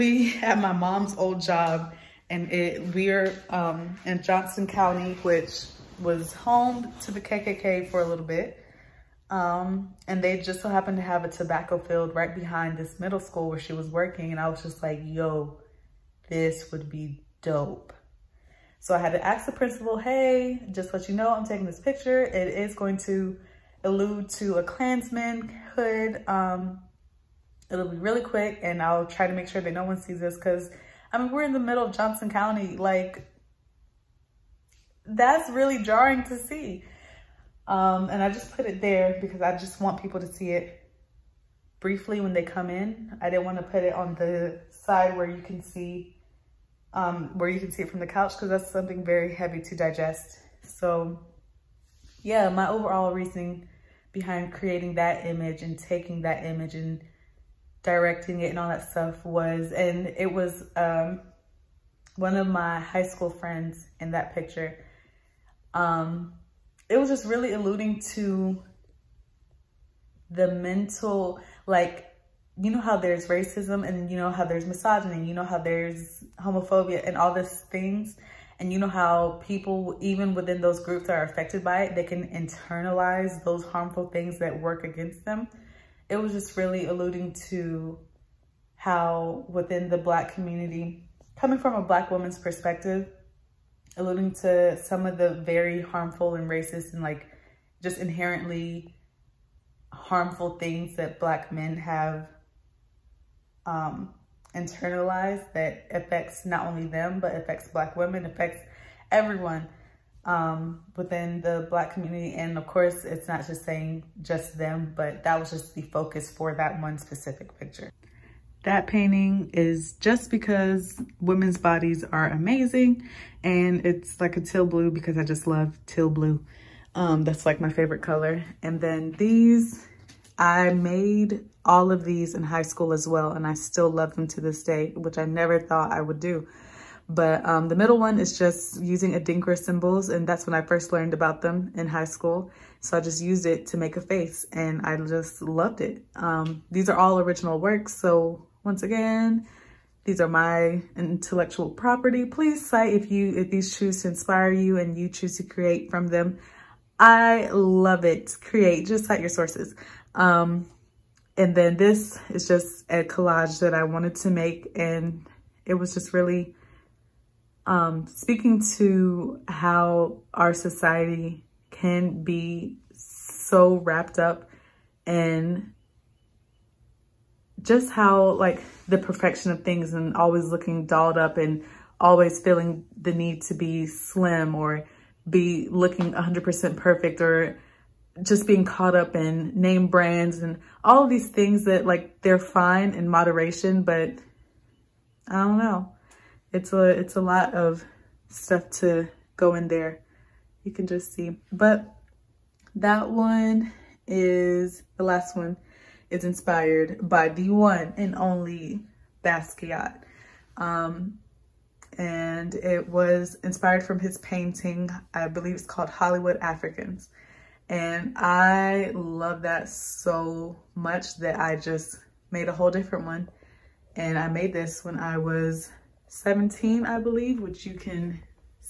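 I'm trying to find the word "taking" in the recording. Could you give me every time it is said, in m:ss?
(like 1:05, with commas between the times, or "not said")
0:21, 0:55.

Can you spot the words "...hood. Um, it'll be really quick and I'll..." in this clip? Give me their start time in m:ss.
0:25.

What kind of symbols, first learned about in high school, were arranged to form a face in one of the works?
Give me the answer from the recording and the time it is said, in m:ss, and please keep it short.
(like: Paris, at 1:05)
Adinkra symbols, at 2:19.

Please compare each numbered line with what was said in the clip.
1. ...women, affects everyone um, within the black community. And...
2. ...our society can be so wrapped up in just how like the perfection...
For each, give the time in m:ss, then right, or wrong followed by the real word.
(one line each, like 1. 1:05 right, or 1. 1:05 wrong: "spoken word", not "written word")
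1. 1:47 right
2. 2:50 right.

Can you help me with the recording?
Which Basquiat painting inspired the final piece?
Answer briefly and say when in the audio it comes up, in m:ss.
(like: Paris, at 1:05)
Hollywood Africans, at 3:35.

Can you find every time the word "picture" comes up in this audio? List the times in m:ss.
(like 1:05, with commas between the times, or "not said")
0:21, 1:04, 1:57.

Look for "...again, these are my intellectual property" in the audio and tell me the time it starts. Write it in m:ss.
2:28.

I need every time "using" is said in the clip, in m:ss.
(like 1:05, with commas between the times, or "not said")
2:18.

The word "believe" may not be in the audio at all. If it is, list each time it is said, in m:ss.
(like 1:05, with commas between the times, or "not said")
3:35, 3:46.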